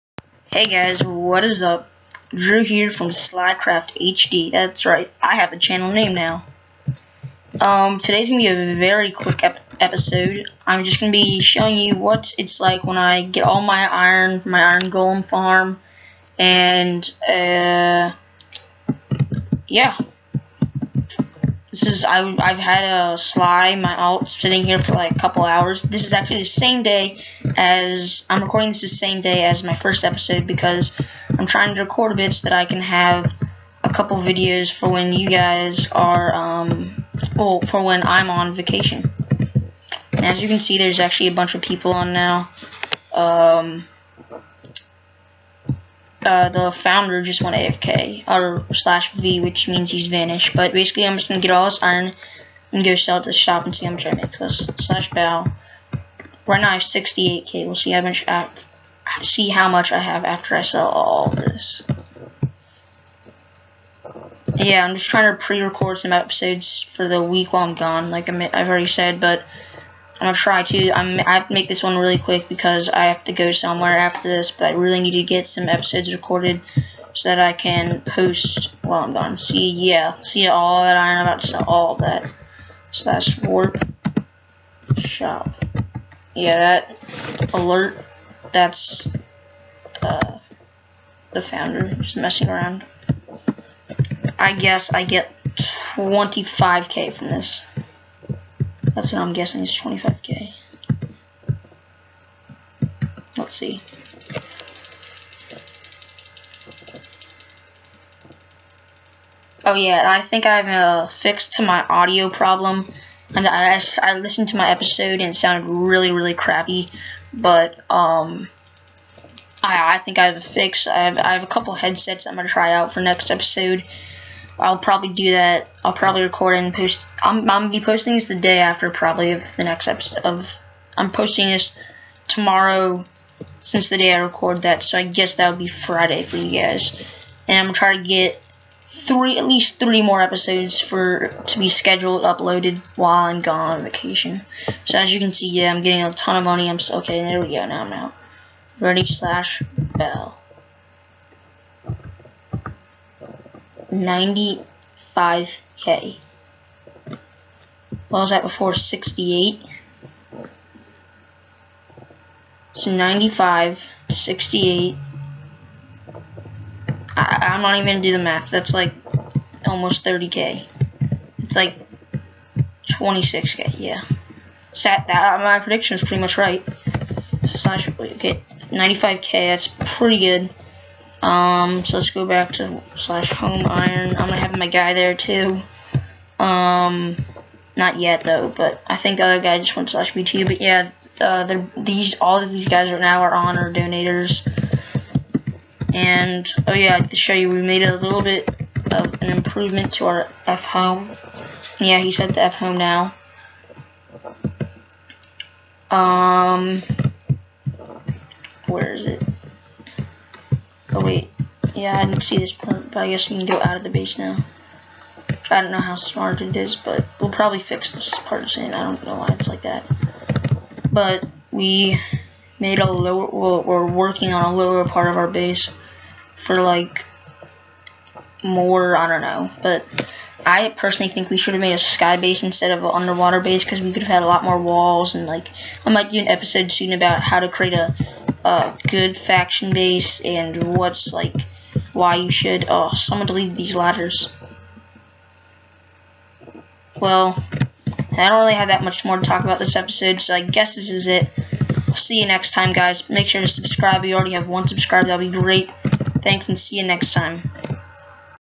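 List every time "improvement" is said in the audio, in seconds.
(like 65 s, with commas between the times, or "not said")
199 s.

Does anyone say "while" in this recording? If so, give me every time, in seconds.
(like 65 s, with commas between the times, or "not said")
67 s, 78 s, 142 s.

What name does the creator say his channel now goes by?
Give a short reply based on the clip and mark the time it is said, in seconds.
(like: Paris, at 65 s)
Slycraft HD, at 3 s.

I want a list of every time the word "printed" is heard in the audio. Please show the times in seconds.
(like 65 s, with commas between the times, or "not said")
not said.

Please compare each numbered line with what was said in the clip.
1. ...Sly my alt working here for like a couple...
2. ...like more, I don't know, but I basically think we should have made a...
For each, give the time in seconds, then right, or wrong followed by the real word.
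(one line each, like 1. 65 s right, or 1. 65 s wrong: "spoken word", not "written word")
1. 23 s wrong: "sitting", not "working"
2. 226 s wrong: "personally", not "basically".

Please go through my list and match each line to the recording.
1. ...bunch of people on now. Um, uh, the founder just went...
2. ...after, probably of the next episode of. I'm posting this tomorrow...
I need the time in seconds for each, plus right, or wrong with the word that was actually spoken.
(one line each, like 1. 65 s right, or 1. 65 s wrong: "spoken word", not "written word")
1. 41 s right
2. 128 s right.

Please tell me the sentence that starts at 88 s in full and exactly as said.
That's uh, the founder just messing around.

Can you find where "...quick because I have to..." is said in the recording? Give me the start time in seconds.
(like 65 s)
72 s.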